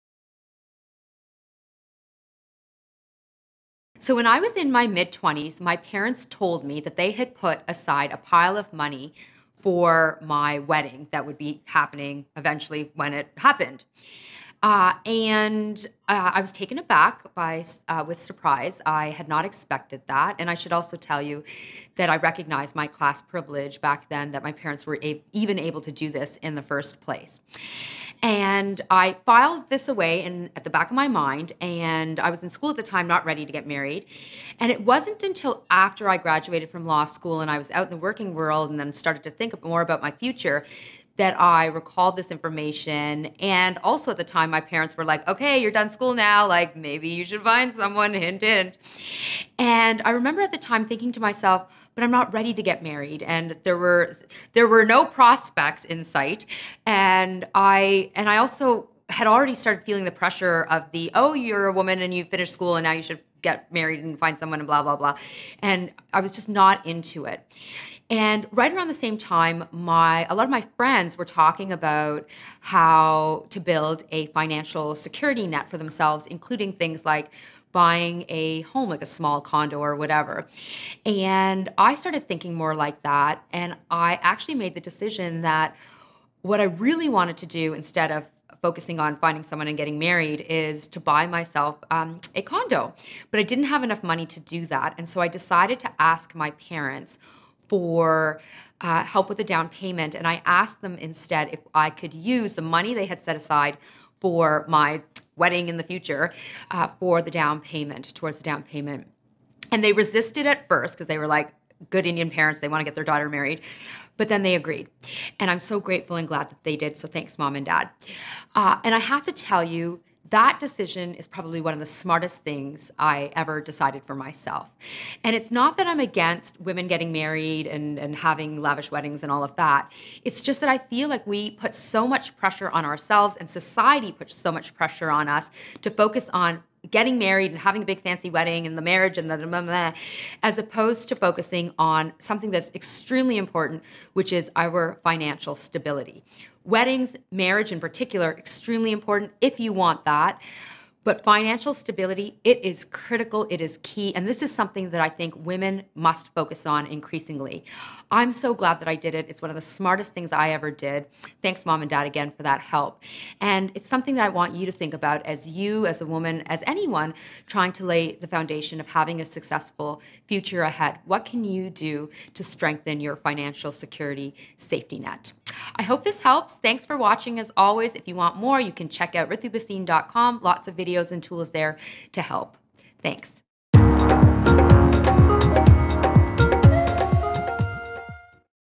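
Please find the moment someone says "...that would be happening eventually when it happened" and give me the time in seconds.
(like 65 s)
11 s.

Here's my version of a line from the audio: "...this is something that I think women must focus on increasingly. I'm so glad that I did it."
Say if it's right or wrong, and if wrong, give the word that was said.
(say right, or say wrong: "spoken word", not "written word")
right.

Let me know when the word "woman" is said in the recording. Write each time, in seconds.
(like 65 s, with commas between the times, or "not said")
61 s, 166 s.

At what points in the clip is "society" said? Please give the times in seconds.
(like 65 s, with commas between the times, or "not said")
133 s.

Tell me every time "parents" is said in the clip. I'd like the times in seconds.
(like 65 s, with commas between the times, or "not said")
5 s, 24 s, 44 s, 96 s, 112 s.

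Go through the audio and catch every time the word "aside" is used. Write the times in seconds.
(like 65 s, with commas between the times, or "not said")
7 s, 103 s.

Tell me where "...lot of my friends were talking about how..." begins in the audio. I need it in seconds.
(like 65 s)
70 s.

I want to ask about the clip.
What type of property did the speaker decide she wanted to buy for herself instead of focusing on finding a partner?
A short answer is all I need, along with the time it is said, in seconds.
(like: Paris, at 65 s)
a condo, at 92 s.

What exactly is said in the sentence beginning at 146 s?
Weddings, marriage in particular, extremely important if you want that.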